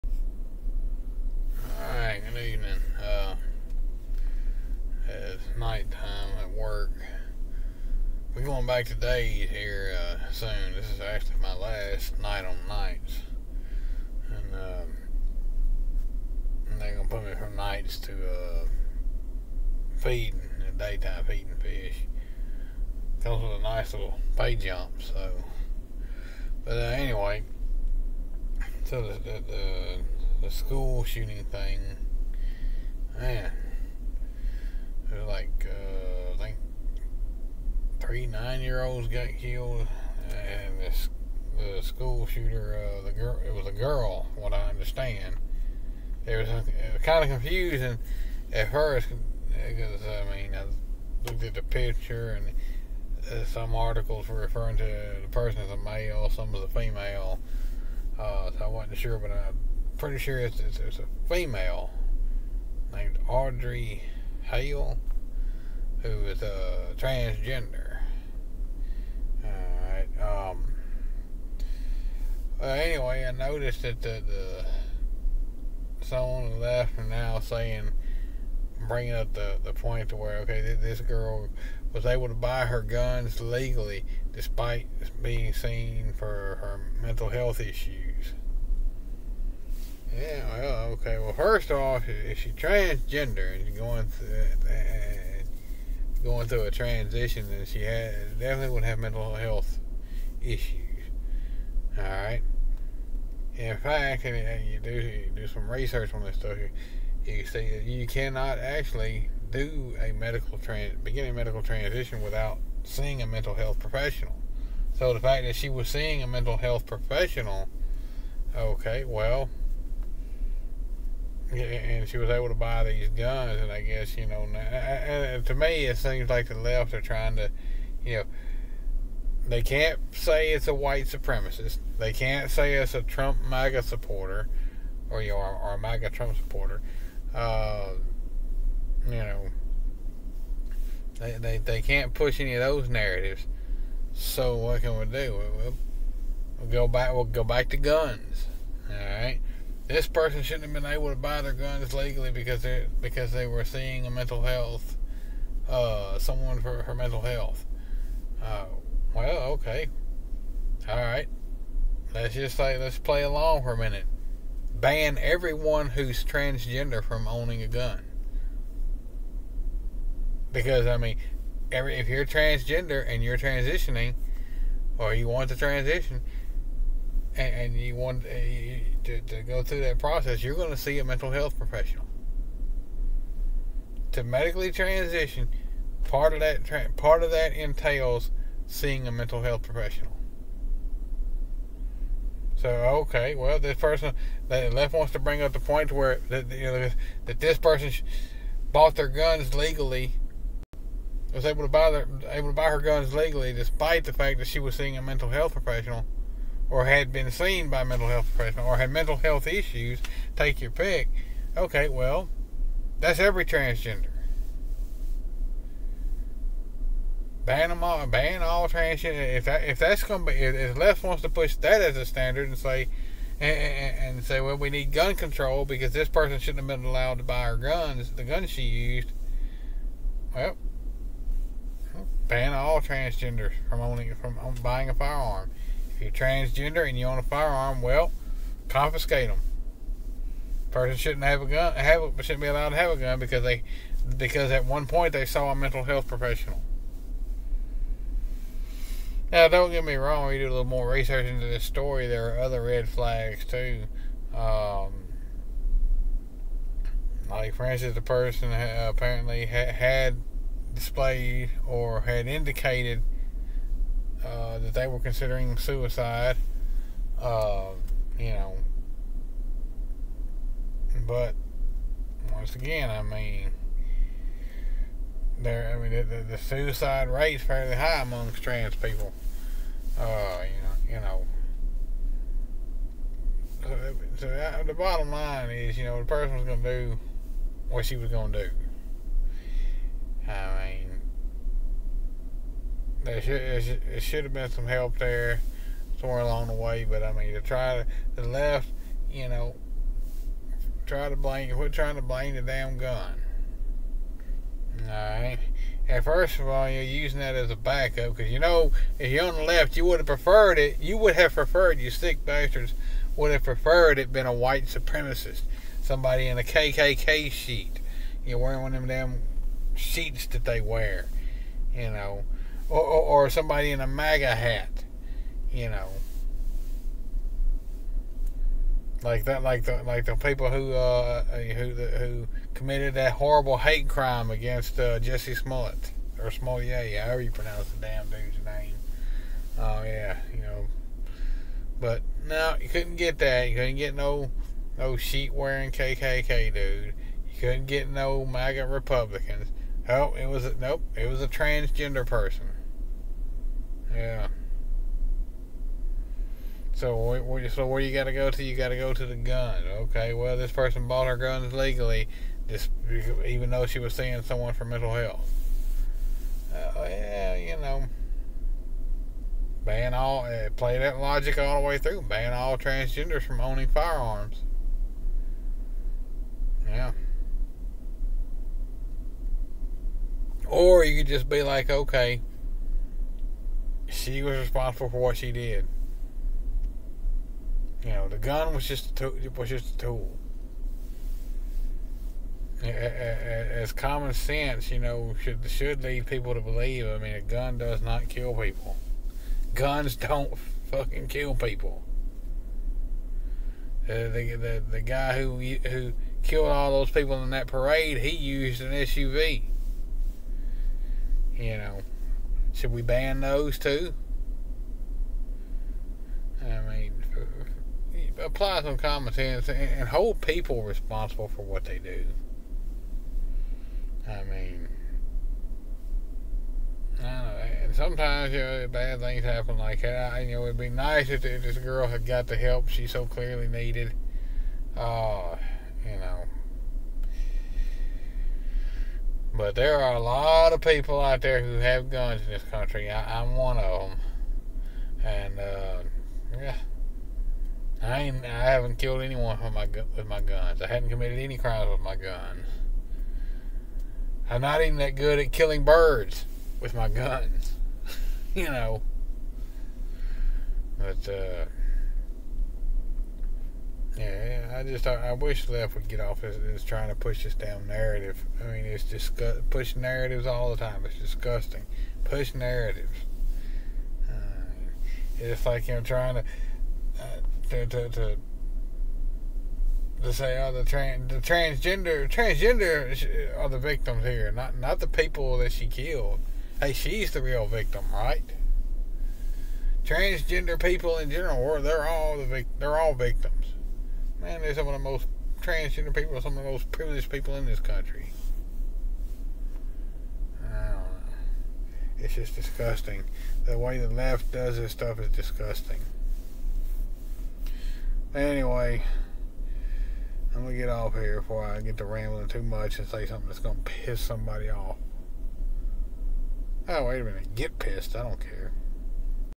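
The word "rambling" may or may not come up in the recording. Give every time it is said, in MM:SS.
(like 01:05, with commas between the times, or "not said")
08:31.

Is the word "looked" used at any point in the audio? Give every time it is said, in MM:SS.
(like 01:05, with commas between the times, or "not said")
00:51.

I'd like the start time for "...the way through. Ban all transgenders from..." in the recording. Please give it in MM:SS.
06:11.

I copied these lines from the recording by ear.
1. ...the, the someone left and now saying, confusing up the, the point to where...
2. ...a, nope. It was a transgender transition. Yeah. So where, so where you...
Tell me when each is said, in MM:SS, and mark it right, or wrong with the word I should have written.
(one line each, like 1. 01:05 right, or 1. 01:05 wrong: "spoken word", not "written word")
1. 01:14 wrong: "bringing", not "confusing"
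2. 05:50 wrong: "person", not "transition".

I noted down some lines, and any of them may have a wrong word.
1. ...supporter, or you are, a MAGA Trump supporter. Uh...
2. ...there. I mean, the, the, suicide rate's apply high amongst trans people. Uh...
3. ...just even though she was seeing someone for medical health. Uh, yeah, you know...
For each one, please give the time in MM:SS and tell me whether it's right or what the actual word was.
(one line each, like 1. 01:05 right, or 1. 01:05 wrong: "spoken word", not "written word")
1. 02:13 right
2. 04:35 wrong: "fairly", not "apply"
3. 06:02 wrong: "mental", not "medical".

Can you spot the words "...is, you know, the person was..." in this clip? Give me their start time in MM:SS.
04:45.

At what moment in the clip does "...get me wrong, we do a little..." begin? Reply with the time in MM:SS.
04:09.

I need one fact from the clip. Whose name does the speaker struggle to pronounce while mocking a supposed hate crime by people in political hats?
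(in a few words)
Jesse Smollett.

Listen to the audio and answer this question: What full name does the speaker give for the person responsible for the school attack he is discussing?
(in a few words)
Audrey Hale.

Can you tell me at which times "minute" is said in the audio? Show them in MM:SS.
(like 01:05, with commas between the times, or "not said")
02:43, 08:37.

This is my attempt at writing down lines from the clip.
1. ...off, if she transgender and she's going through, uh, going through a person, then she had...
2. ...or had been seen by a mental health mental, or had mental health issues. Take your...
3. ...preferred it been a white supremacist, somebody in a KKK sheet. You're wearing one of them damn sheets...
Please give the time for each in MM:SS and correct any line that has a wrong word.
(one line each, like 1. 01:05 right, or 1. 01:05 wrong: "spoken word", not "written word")
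1. 01:31 wrong: "transition", not "person"
2. 03:26 wrong: "professional", not "mental"
3. 05:13 right.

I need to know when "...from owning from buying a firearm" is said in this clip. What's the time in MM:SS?
03:53.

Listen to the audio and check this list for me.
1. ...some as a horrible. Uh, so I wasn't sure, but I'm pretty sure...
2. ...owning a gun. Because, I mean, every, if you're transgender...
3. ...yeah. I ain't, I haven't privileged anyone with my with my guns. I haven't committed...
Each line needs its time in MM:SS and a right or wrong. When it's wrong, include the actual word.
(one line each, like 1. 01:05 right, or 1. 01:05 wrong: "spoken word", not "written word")
1. 00:56 wrong: "female", not "horrible"
2. 02:47 right
3. 07:26 wrong: "killed", not "privileged".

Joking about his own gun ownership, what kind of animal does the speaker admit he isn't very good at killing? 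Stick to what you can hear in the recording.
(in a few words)
Birds.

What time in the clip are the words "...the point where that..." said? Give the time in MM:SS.
03:15.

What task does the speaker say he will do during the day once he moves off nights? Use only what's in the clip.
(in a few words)
Feeding fish.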